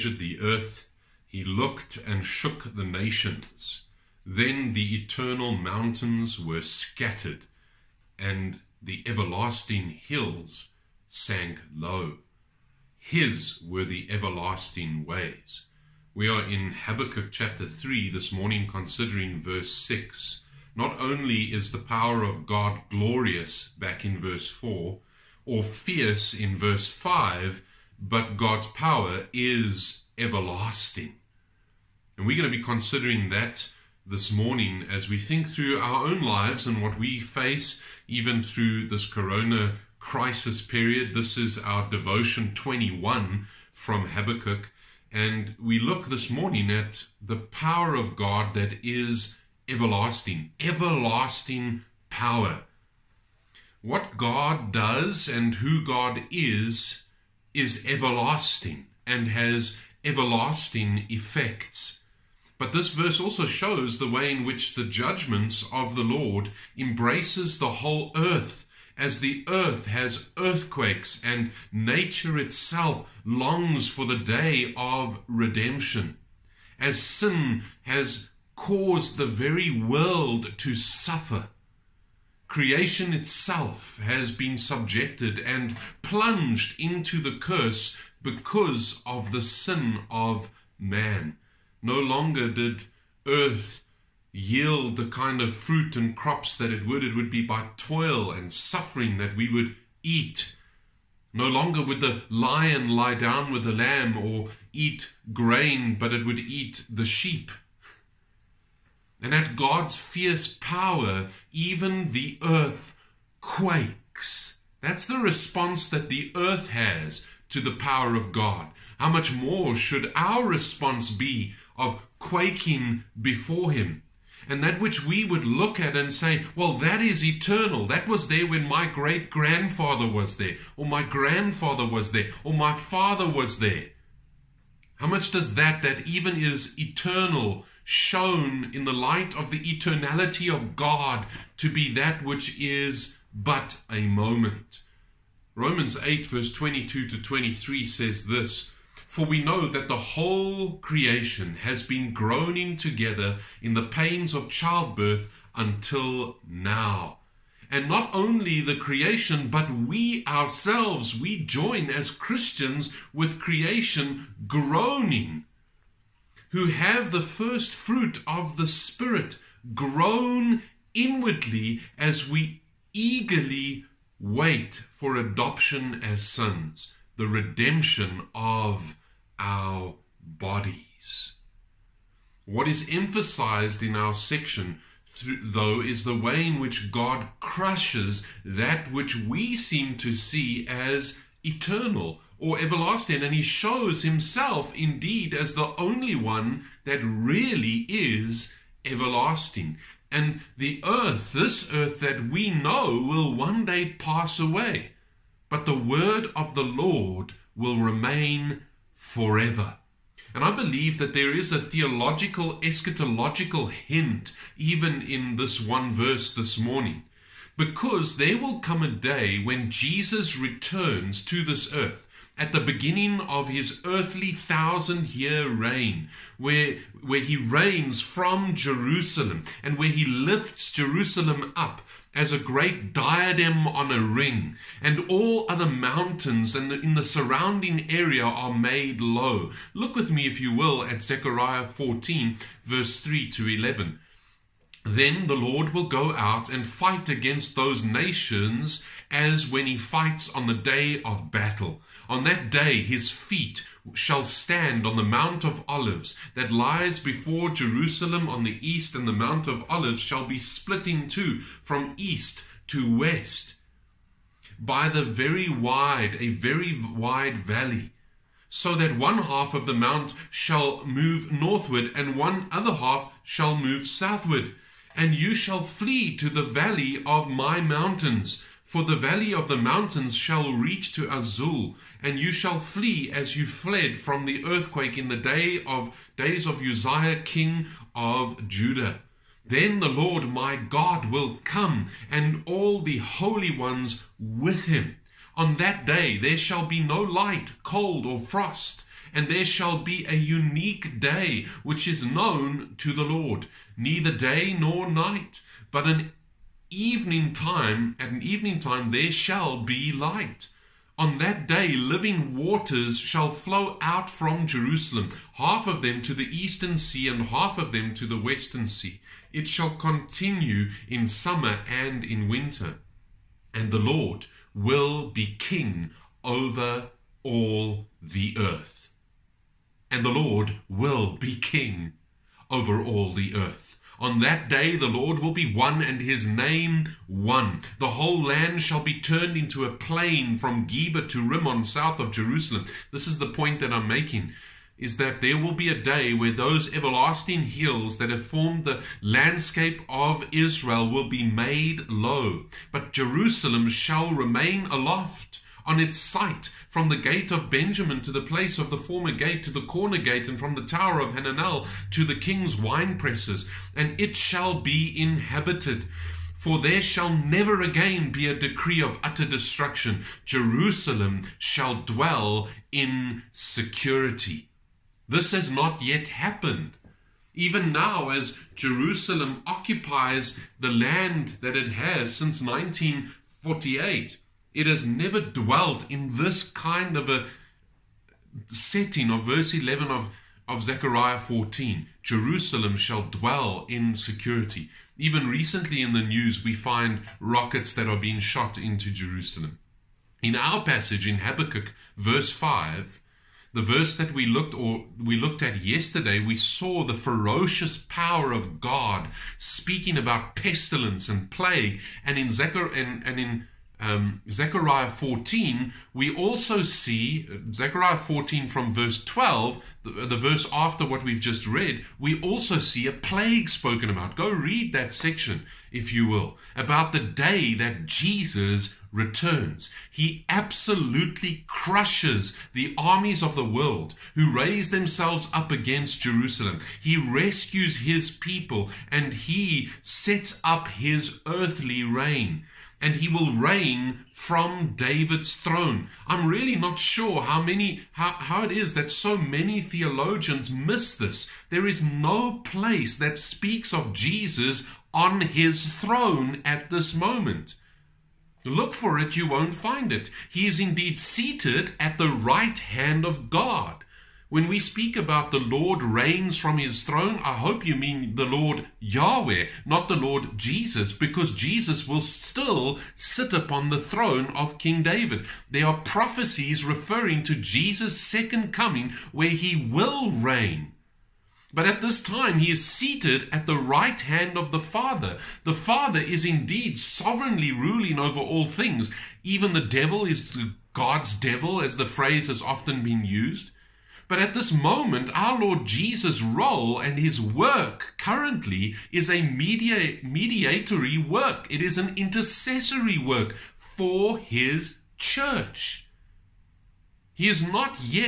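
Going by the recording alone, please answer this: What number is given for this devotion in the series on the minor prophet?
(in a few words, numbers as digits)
21.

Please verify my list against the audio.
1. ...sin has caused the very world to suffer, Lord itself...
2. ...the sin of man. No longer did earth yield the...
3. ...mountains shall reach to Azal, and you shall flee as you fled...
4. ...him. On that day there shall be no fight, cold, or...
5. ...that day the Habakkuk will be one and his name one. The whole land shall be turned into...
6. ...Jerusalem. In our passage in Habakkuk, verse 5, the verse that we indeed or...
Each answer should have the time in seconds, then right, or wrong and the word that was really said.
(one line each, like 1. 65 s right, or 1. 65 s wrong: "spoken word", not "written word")
1. 77 s wrong: "Creation", not "Lord"
2. 89 s right
3. 279 s right
4. 294 s wrong: "light", not "fight"
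5. 334 s wrong: "Lord", not "Habakkuk"
6. 398 s wrong: "looked", not "indeed".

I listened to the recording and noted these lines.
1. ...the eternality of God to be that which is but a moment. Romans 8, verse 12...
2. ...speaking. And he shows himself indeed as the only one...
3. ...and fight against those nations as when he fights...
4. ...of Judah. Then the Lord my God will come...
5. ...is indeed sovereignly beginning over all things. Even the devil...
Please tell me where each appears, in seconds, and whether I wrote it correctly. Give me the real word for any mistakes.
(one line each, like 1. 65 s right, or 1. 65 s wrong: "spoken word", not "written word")
1. 139 s wrong: "22", not "12"
2. 192 s wrong: "everlasting", not "speaking"
3. 246 s right
4. 287 s right
5. 486 s wrong: "ruling", not "beginning".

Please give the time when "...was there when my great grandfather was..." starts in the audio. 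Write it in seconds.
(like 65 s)
128 s.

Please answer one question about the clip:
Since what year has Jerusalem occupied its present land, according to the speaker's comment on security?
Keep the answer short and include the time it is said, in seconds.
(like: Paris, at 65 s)
1948, at 382 s.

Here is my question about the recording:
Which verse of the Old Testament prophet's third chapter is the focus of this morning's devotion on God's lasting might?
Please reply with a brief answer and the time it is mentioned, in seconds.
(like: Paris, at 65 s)
Verse 6, at 19 s.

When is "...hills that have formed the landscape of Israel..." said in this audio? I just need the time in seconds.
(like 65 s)
347 s.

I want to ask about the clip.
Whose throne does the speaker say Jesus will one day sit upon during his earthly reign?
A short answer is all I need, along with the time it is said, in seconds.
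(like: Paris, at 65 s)
King David, at 474 s.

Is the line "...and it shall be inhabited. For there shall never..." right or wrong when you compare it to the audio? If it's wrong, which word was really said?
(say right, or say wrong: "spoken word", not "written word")
right.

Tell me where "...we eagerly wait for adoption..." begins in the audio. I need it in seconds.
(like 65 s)
172 s.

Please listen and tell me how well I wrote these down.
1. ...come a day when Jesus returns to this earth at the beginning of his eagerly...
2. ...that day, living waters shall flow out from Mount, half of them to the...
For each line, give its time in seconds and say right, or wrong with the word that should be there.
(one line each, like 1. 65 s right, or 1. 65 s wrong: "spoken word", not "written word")
1. 218 s wrong: "earthly", not "eagerly"
2. 311 s wrong: "Jerusalem", not "Mount".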